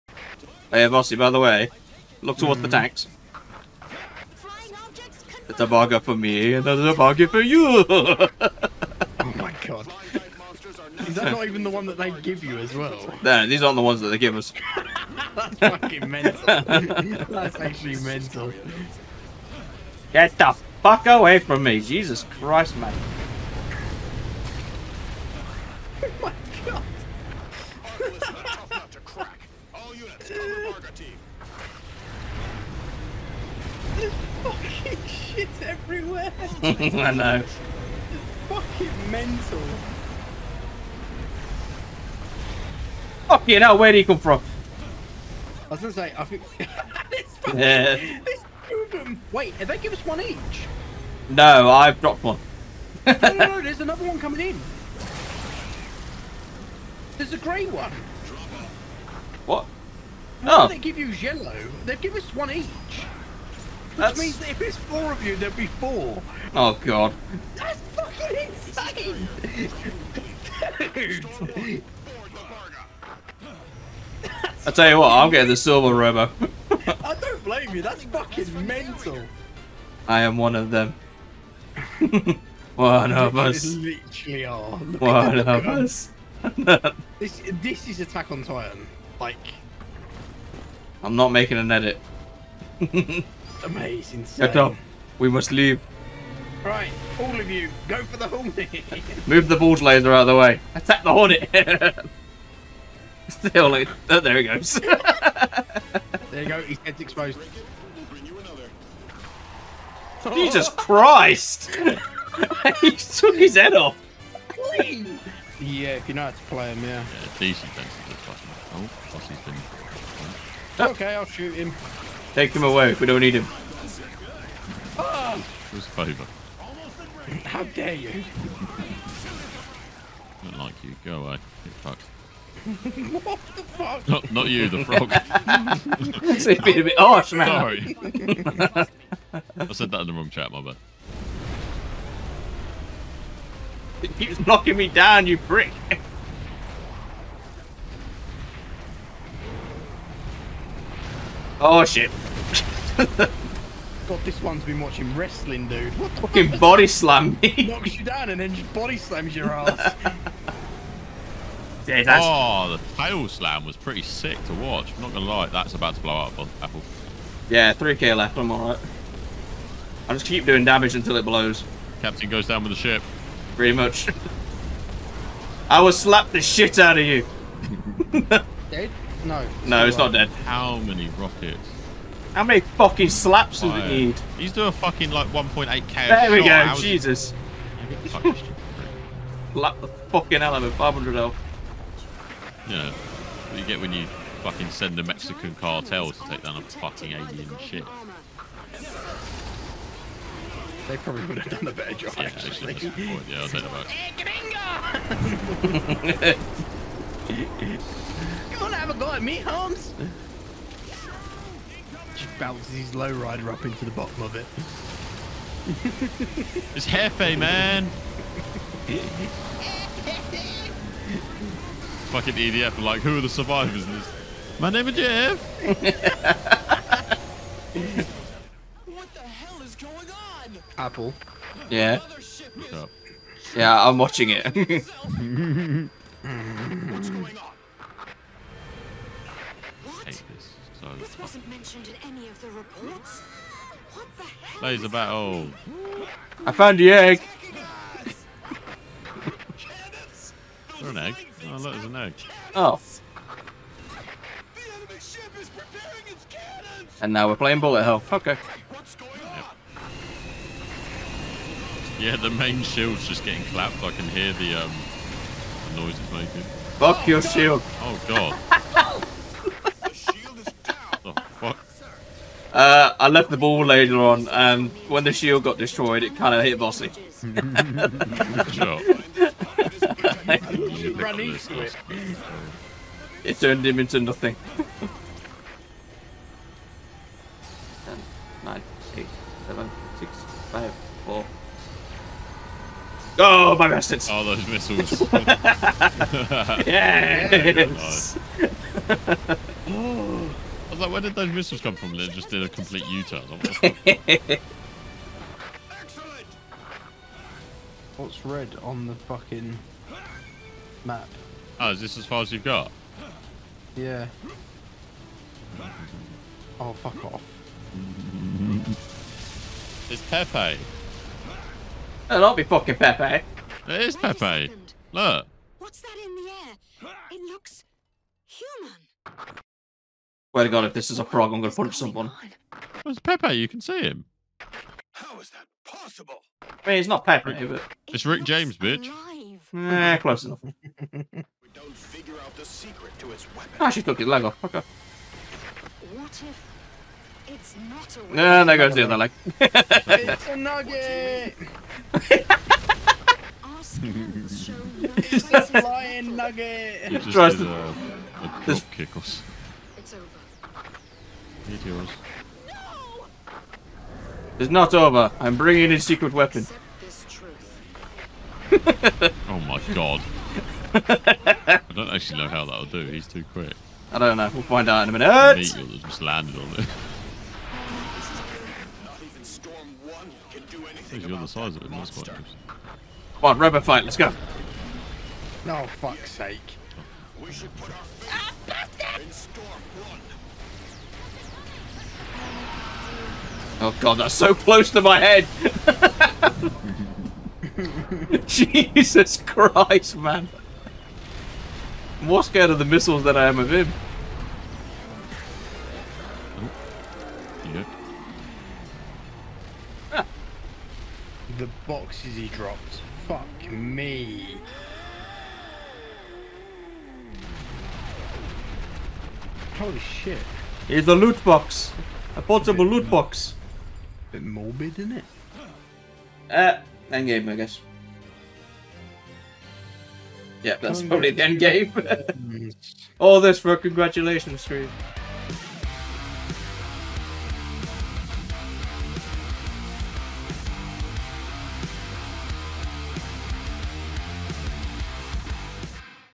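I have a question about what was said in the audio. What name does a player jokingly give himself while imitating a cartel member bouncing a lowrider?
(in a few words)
Jeff.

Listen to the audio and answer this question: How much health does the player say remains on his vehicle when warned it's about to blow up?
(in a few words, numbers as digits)
3k.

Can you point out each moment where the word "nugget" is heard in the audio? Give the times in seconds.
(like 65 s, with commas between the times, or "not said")
350 s, 356 s.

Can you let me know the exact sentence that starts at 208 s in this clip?
You wanna have a go at me, Holmes?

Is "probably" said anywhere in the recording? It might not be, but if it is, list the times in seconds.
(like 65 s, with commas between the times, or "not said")
200 s, 430 s.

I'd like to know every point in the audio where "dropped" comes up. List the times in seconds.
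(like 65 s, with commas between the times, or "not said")
52 s, 412 s.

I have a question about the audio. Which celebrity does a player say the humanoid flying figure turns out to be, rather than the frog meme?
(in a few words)
Rick James.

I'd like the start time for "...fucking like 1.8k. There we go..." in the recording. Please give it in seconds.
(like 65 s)
184 s.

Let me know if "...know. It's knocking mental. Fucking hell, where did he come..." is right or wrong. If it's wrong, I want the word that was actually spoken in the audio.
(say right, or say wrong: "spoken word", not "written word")
wrong: "fucking", not "knocking".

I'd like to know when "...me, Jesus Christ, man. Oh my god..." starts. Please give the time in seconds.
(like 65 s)
21 s.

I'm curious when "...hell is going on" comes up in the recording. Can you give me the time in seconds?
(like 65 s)
229 s.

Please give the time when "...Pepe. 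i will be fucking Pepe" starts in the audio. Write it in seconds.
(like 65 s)
320 s.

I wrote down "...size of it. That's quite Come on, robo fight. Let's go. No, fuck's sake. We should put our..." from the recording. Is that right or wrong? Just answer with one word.
right.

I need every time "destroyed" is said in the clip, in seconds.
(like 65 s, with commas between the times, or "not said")
275 s.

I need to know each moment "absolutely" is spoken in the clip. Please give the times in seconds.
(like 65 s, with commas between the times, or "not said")
not said.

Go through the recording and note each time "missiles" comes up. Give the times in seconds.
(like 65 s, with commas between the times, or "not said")
294 s, 301 s, 402 s.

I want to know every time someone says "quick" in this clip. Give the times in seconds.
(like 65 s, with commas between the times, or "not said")
373 s.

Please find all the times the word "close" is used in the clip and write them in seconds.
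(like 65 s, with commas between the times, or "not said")
339 s, 394 s.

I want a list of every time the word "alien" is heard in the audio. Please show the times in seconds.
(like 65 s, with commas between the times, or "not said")
197 s.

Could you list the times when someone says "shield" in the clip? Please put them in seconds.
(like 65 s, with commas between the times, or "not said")
262 s, 267 s, 275 s.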